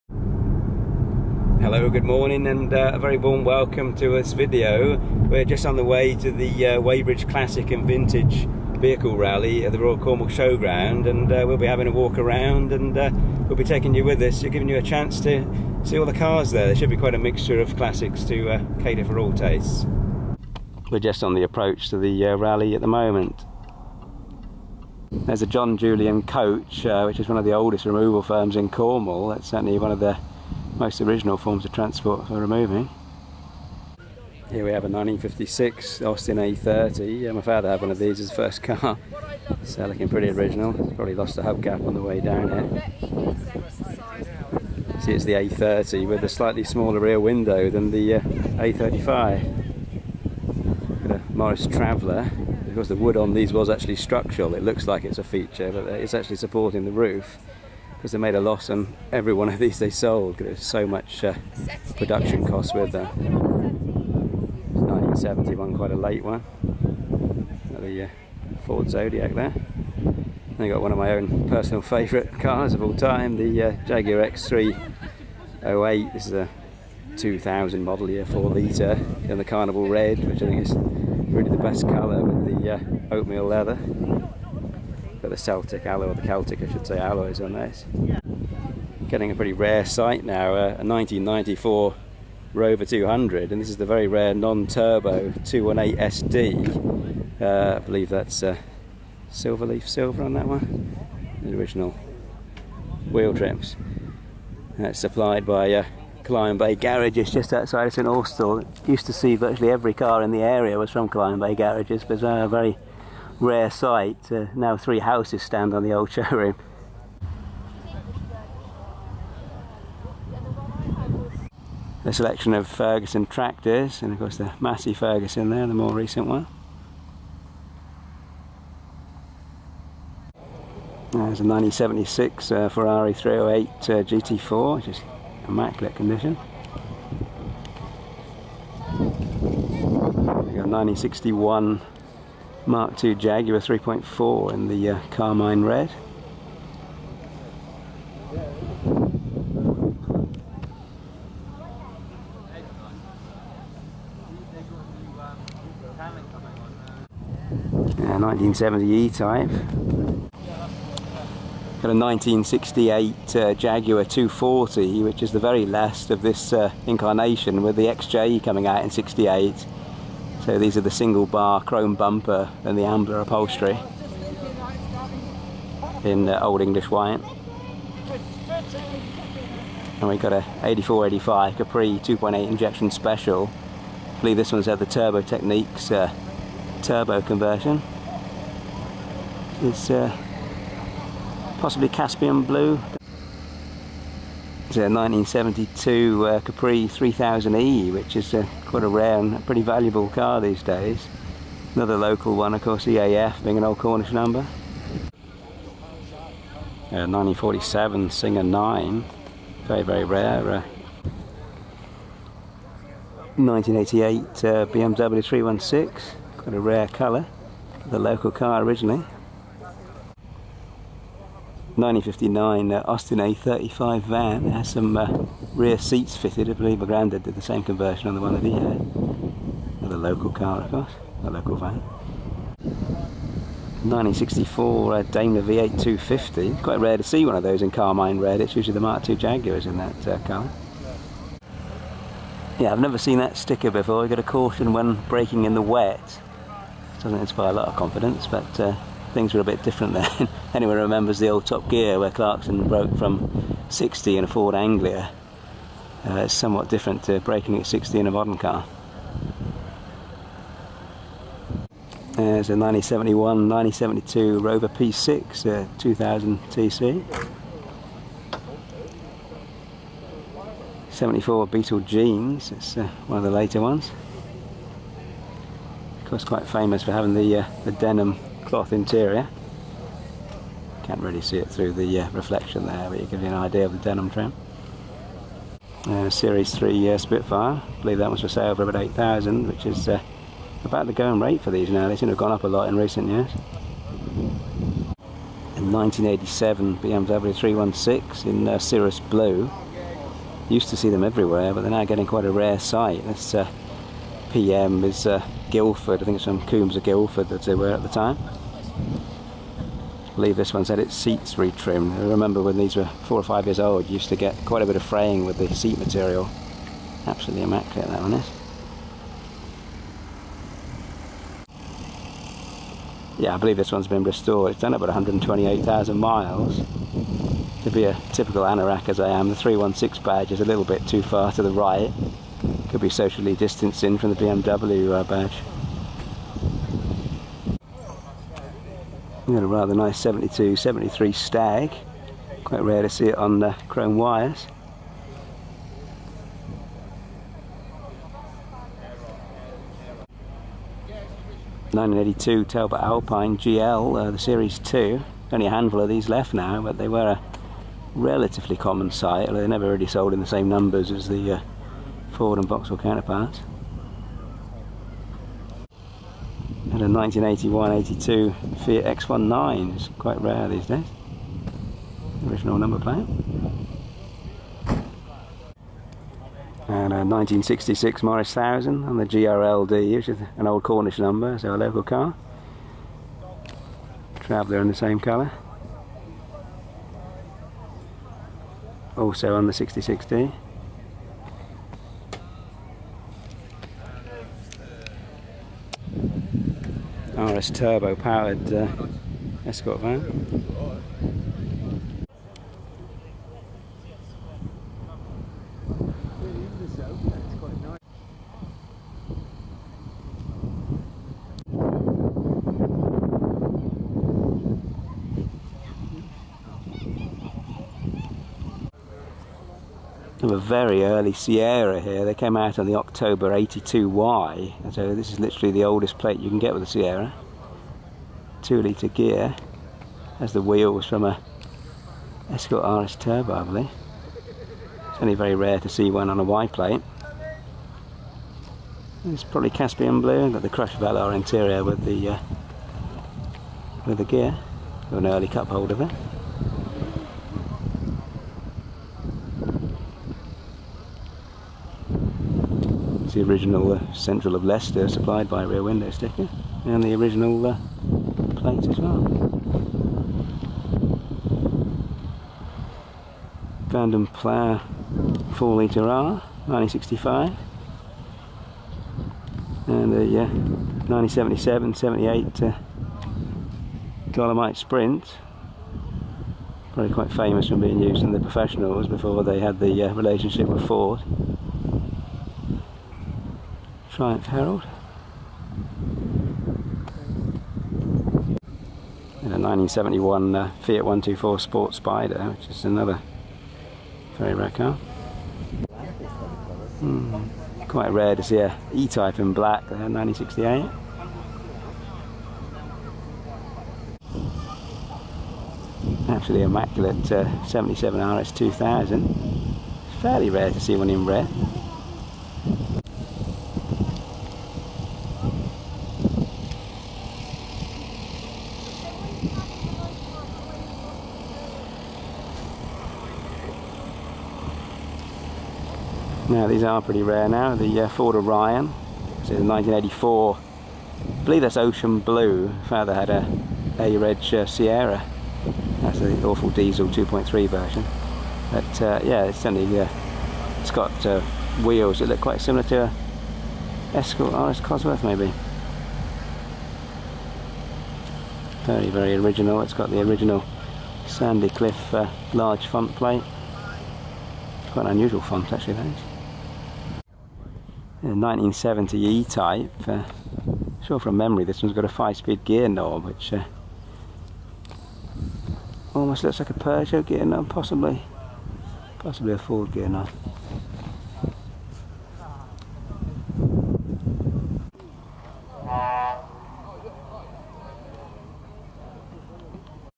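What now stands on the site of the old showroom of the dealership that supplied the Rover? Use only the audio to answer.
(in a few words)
Three houses.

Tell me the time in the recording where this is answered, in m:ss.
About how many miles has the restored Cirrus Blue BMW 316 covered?
5:24.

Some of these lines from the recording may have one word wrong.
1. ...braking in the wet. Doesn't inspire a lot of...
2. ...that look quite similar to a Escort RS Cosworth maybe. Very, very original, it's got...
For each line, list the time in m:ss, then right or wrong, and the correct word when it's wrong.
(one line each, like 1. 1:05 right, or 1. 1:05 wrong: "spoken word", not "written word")
1. 4:05 right
2. 9:01 right.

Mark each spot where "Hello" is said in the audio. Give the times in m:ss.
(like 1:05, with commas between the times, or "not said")
0:01.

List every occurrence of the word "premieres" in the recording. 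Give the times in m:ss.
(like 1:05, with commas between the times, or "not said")
not said.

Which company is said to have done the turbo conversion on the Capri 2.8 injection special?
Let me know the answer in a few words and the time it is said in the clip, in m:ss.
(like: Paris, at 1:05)
Turbo Techniques, at 3:04.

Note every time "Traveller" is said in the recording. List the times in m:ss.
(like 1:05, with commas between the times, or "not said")
0:51, 6:24.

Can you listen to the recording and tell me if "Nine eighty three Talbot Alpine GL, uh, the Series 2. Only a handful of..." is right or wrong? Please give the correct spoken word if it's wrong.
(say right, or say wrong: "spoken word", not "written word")
wrong: "two", not "three".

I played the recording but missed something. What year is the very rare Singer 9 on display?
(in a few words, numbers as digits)
1947.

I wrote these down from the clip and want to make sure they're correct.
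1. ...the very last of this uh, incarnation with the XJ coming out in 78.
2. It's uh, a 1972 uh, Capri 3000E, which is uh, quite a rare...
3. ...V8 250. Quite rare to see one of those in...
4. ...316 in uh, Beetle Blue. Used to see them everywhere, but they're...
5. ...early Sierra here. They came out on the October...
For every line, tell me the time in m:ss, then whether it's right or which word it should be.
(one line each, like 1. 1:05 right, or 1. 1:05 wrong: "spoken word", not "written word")
1. 2:45 wrong: "68", not "78"
2. 3:14 right
3. 3:55 right
4. 4:57 wrong: "Cirrus", not "Beetle"
5. 7:00 right.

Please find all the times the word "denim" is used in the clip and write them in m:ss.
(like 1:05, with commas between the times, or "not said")
4:37, 4:43.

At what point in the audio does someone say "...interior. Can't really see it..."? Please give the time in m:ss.
4:38.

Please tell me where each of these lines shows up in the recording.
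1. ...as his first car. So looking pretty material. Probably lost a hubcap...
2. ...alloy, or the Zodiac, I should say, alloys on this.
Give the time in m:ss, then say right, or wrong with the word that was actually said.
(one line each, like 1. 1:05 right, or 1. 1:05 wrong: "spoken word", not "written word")
1. 0:38 wrong: "original", not "material"
2. 1:25 wrong: "Celtic", not "Zodiac".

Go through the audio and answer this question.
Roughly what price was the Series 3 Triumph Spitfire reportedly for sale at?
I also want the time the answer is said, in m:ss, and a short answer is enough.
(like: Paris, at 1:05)
8,000, at 4:48.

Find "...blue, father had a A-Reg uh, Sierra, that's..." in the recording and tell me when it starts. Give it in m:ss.
8:51.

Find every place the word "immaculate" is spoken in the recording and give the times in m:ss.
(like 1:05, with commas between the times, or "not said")
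2:15, 5:17, 8:26.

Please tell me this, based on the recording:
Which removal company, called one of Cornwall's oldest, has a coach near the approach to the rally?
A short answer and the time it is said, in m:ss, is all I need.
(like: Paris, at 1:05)
John Julian, at 0:25.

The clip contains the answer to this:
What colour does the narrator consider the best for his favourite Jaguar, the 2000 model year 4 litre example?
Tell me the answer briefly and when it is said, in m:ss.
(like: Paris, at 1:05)
Carnival Red, at 1:19.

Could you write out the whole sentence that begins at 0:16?
There should be quite a mixture of classics to uh, cater for all tastes.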